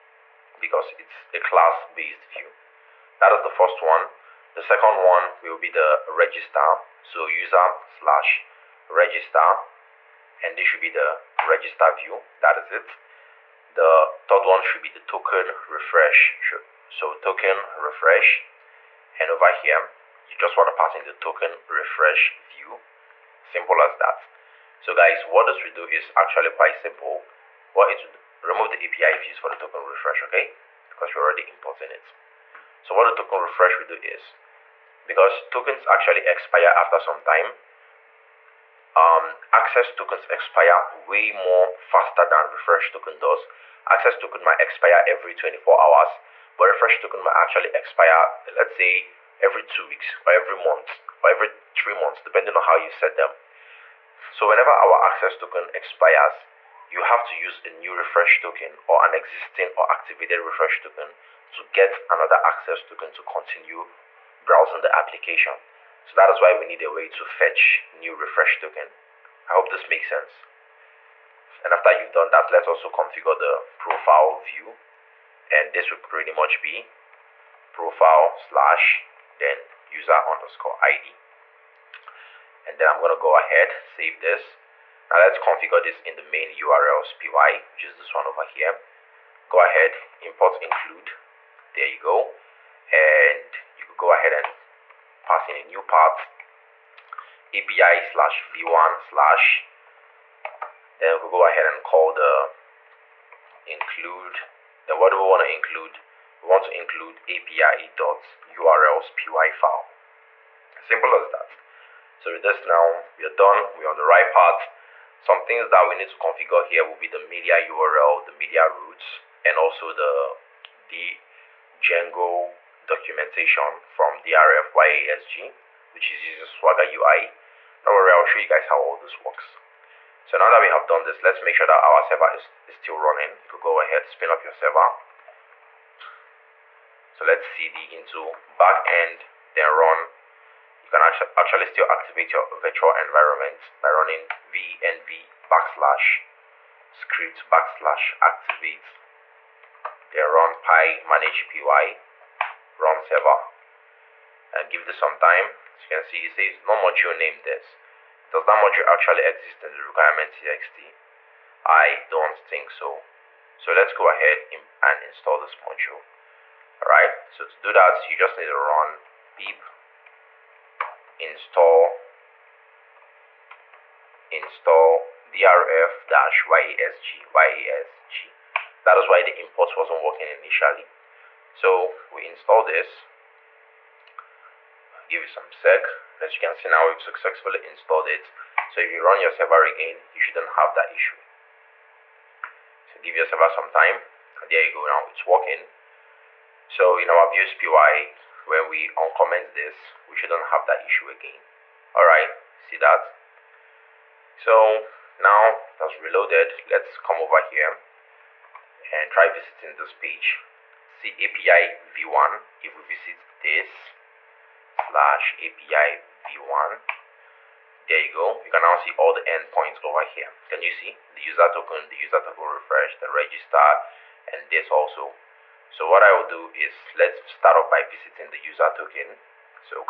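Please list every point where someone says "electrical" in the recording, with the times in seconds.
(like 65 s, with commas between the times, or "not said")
not said.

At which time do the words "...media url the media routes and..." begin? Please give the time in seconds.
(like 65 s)
117 s.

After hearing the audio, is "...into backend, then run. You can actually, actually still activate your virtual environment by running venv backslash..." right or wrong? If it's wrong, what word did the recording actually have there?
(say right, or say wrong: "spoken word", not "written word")
right.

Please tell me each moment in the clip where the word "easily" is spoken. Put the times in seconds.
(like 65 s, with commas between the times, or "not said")
not said.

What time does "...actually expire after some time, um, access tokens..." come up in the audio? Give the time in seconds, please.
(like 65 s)
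35 s.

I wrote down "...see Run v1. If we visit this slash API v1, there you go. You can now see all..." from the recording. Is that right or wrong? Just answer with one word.
wrong.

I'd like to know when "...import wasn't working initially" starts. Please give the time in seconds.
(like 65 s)
179 s.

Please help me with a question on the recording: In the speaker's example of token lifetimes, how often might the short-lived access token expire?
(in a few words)
every 24 hours.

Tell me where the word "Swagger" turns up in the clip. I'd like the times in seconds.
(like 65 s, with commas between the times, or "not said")
126 s.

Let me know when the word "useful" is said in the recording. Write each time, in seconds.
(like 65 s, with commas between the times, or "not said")
not said.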